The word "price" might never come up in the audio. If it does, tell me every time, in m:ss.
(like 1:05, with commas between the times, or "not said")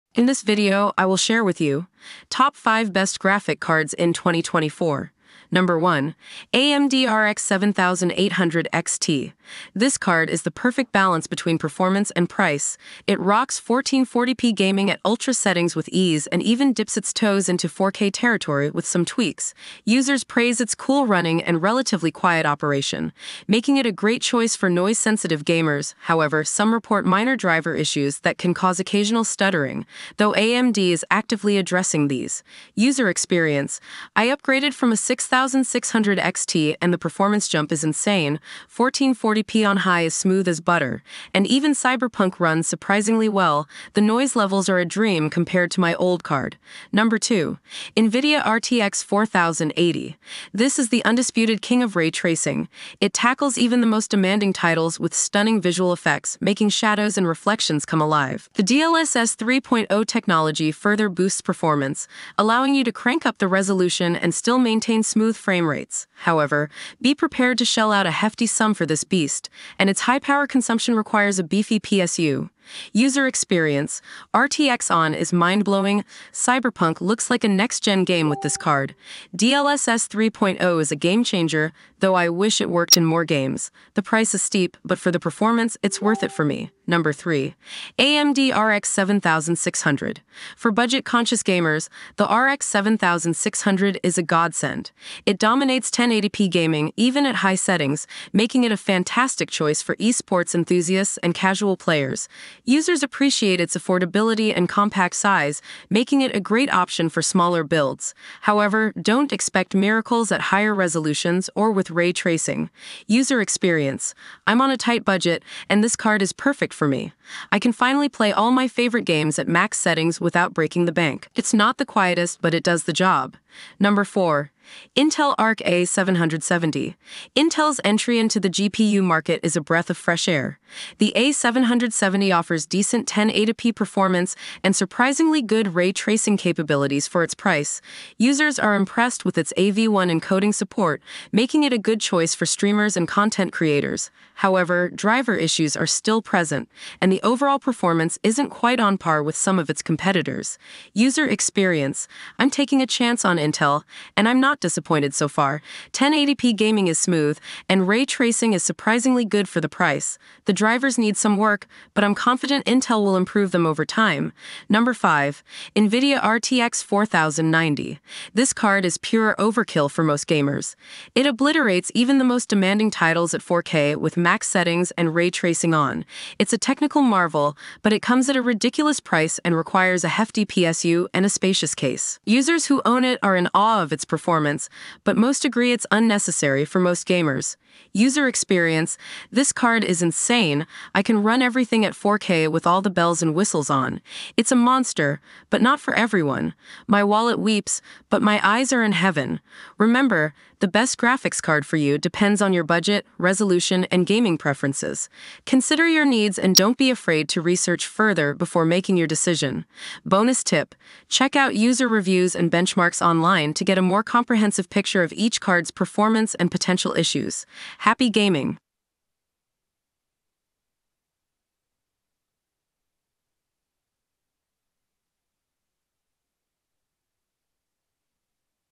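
0:12, 1:24, 2:17, 2:39, 2:58.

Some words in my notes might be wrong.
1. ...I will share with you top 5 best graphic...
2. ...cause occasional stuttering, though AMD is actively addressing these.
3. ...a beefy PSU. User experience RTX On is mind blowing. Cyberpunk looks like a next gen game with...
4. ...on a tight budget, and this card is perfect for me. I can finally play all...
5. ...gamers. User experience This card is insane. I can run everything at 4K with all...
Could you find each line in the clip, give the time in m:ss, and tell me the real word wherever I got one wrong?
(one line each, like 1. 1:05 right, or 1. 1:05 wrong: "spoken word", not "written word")
1. 0:00 right
2. 0:28 right
3. 1:11 right
4. 1:54 right
5. 3:07 right.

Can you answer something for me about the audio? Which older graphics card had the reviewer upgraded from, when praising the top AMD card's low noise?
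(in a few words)
6600 XT.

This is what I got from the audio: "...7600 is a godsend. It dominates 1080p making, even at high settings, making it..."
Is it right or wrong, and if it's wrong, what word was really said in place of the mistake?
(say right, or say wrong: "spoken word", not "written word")
wrong: "gaming", not "making".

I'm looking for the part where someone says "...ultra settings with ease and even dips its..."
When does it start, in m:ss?
0:15.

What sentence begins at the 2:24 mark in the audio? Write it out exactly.
However, driver issues are still present, and the overall performance isn't quite on par with some of its competitors.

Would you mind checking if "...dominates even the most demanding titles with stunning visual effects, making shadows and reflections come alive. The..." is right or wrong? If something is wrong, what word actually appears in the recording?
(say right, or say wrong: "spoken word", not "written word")
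wrong: "tackles", not "dominates".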